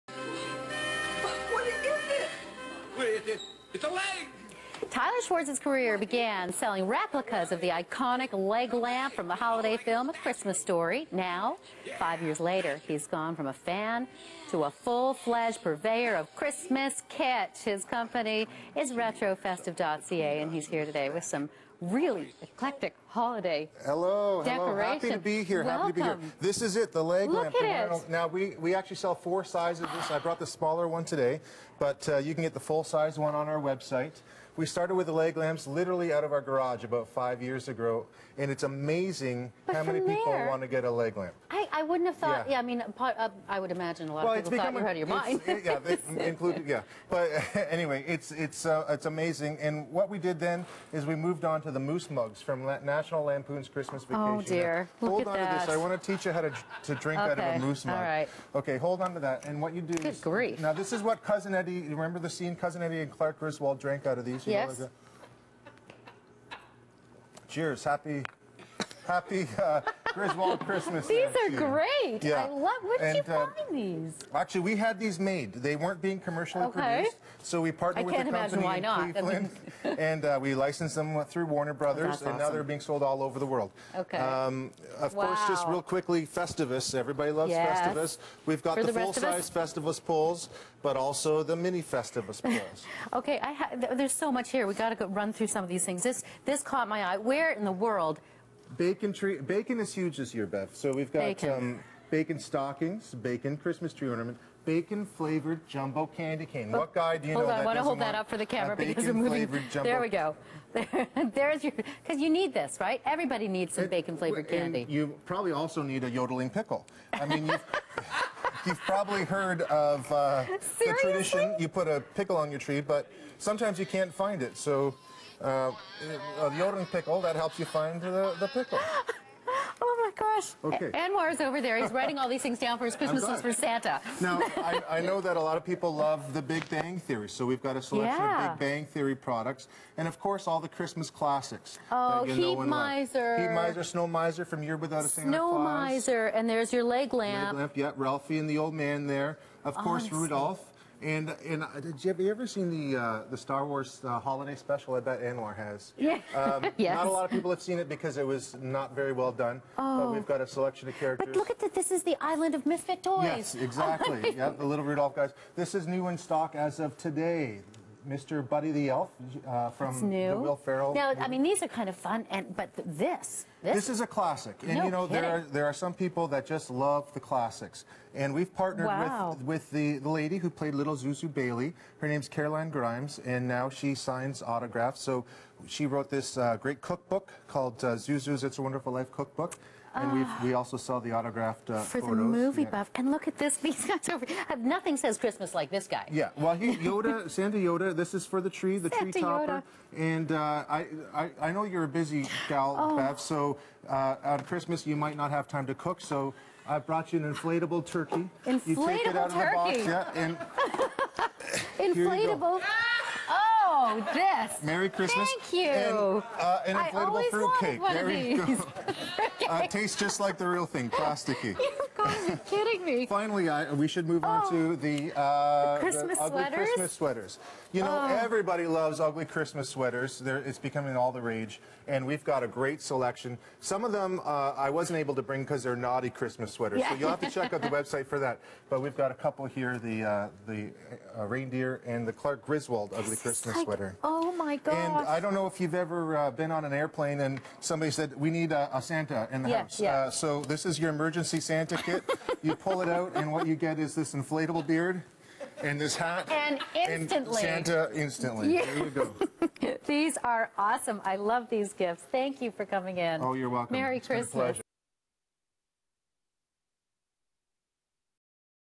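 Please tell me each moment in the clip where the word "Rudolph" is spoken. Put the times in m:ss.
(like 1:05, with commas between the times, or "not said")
2:30, 2:44.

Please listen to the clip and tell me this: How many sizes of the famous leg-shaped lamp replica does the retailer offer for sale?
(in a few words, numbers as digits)
4.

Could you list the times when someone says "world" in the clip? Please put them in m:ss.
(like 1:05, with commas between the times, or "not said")
1:23, 1:37.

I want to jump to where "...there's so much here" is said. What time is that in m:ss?
1:33.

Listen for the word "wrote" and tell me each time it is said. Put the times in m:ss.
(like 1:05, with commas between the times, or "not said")
3:05.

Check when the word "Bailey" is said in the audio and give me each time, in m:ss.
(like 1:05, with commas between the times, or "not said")
3:01.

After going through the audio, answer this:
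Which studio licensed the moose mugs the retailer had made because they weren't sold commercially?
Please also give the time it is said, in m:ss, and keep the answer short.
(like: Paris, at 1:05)
Warner Brothers, at 1:21.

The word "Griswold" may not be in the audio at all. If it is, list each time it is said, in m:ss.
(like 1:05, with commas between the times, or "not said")
1:03, 1:10, 4:02.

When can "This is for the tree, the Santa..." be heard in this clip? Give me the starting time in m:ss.
3:17.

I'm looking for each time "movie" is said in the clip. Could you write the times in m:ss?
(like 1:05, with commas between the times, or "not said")
1:49, 3:12.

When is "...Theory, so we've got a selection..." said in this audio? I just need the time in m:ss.
2:16.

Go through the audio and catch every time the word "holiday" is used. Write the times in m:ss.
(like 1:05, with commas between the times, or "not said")
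0:09, 0:23, 2:34.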